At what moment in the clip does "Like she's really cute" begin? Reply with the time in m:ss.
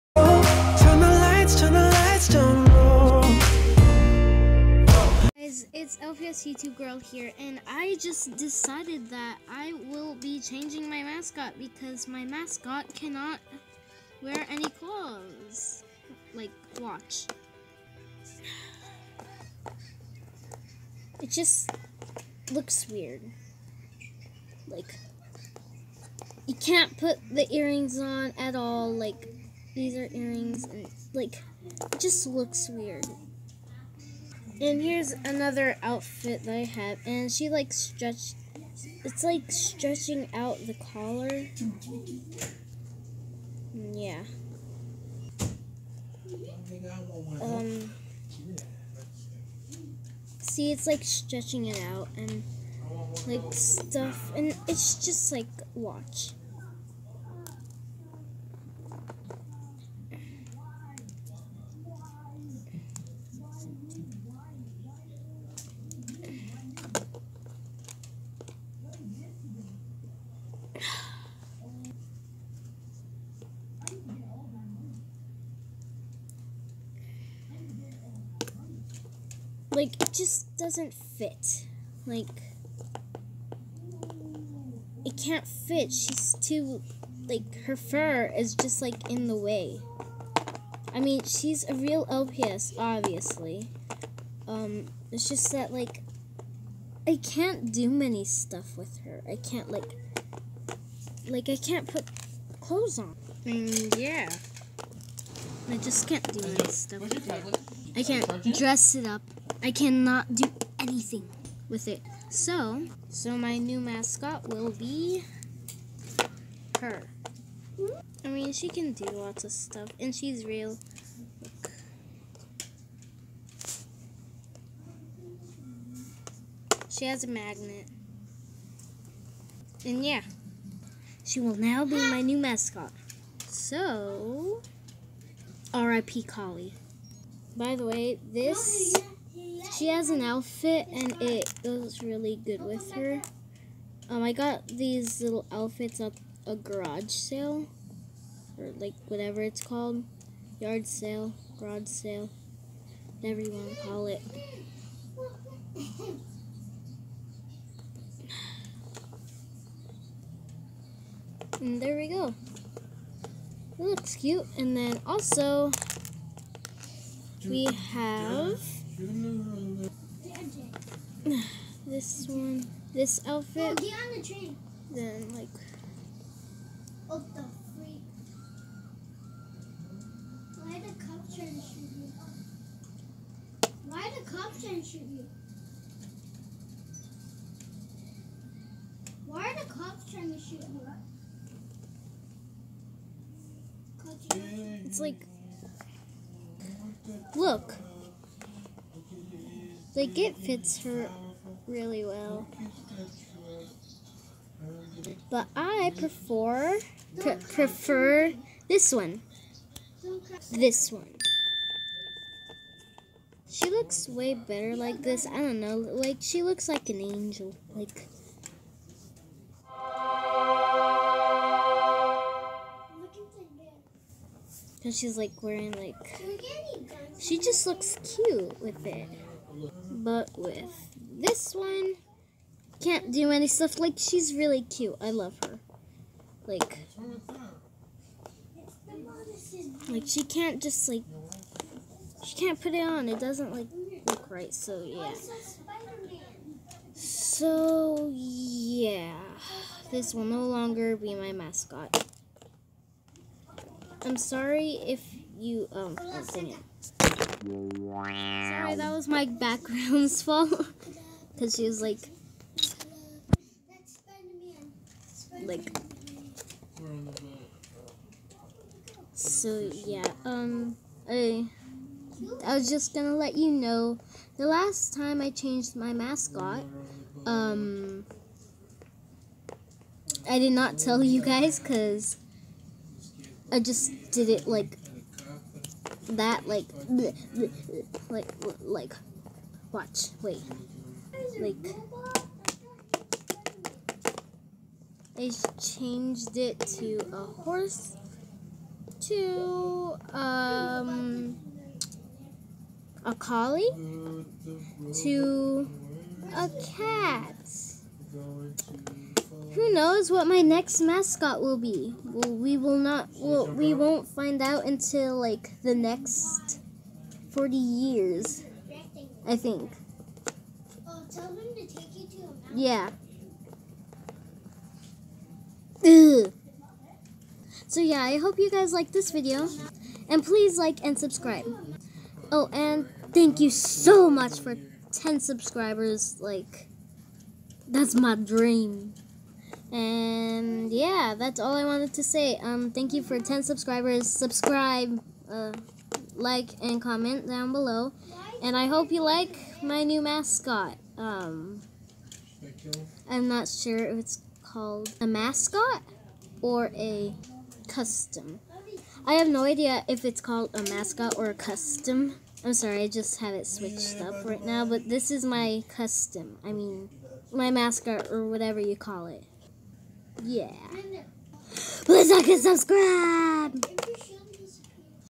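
3:53.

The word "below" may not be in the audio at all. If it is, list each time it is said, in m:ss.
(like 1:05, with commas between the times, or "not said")
5:47.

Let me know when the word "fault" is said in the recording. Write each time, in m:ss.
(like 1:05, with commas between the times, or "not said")
4:20.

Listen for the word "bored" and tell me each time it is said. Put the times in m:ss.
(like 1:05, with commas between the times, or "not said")
not said.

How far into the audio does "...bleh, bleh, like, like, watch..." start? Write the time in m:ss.
4:47.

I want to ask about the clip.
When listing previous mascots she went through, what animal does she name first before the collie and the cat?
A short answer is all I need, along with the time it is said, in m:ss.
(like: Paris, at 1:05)
horse, at 4:57.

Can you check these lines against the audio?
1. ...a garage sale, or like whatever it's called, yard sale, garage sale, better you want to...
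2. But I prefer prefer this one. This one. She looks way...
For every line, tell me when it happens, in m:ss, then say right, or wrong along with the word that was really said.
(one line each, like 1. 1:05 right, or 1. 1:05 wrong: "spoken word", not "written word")
1. 2:26 wrong: "whatever", not "better"
2. 3:25 right.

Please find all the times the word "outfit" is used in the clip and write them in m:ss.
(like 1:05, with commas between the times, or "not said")
0:35, 2:20, 2:25, 2:53.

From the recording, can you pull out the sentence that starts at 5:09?
Who knows what my next mascot will be?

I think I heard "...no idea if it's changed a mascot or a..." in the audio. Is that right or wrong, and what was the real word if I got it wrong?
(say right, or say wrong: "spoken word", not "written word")
wrong: "called", not "changed".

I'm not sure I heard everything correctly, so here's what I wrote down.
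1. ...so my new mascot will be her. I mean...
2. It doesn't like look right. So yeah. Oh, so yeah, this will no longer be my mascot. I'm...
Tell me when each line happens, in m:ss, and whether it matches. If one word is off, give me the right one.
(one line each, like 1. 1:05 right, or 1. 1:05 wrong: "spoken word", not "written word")
1. 1:53 right
2. 4:03 right.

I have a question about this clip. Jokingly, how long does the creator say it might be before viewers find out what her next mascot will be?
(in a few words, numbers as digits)
forty years.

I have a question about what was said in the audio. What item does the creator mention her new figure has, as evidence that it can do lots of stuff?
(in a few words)
a magnet.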